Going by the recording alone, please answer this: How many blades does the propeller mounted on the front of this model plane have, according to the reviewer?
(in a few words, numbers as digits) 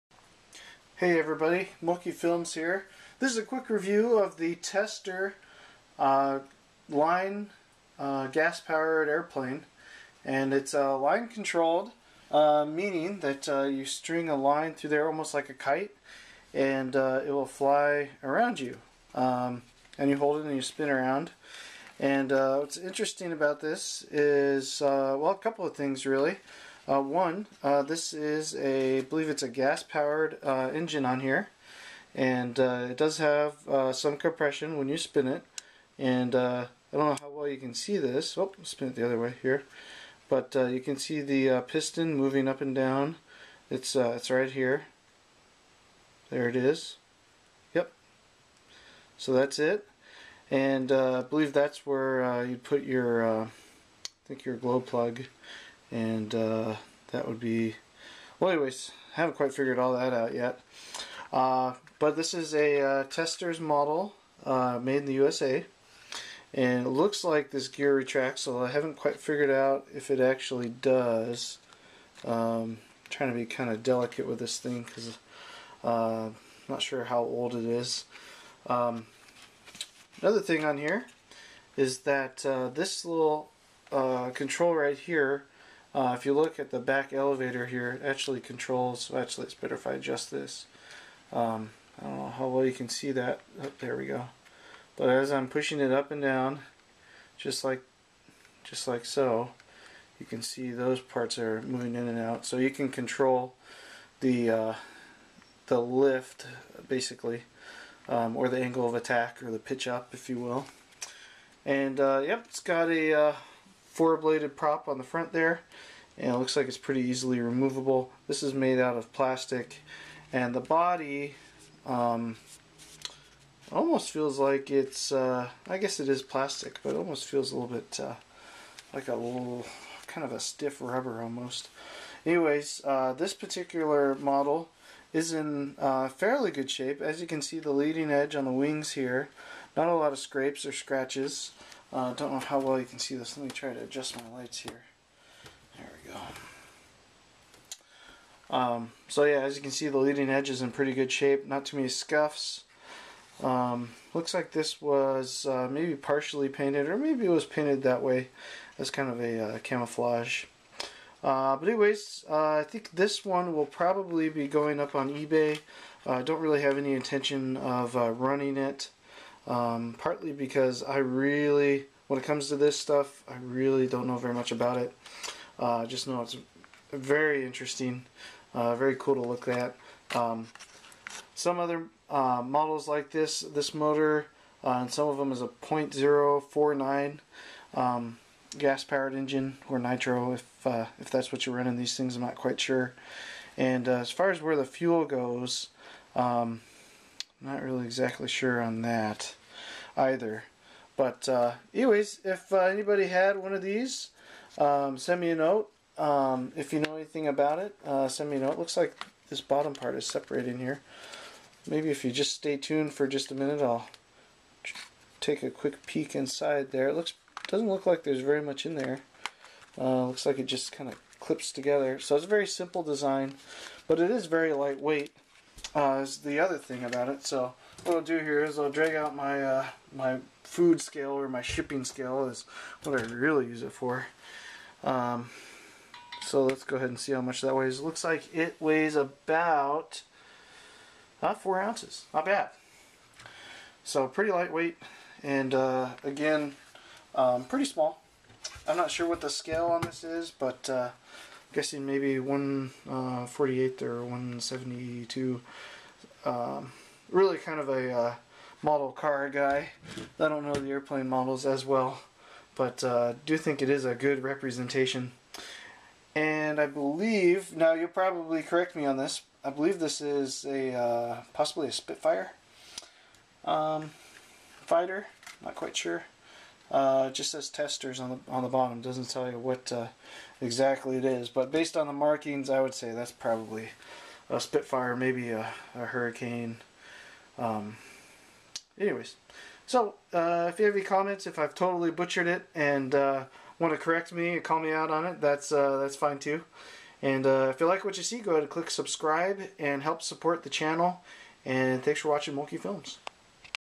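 4.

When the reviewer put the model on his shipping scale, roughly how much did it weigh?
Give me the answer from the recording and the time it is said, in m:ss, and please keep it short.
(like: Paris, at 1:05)
about 4 ounces, at 3:58.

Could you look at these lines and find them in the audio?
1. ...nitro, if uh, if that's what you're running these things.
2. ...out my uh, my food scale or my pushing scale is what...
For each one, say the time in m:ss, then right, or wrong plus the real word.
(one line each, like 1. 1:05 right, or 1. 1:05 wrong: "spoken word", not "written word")
1. 3:09 right
2. 3:48 wrong: "shipping", not "pushing".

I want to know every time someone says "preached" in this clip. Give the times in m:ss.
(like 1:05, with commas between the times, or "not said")
not said.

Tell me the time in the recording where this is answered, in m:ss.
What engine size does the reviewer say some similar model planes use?
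3:05.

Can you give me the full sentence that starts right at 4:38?
Doesn't tell you what uh, exactly it is.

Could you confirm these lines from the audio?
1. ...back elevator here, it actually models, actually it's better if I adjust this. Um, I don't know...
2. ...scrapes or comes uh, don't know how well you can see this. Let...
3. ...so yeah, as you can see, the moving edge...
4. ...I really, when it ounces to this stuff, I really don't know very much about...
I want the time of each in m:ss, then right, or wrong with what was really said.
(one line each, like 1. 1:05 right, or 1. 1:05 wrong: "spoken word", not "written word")
1. 1:26 wrong: "controls", not "models"
2. 2:20 wrong: "scratches", not "comes"
3. 2:29 wrong: "leading", not "moving"
4. 2:50 wrong: "comes", not "ounces".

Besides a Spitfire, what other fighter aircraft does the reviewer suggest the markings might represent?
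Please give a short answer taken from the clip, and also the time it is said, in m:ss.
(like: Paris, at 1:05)
Hurricane, at 4:45.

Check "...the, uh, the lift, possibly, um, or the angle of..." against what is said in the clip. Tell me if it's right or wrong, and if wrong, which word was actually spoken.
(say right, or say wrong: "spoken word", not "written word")
wrong: "basically", not "possibly".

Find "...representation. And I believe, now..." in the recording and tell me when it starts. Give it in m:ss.
4:24.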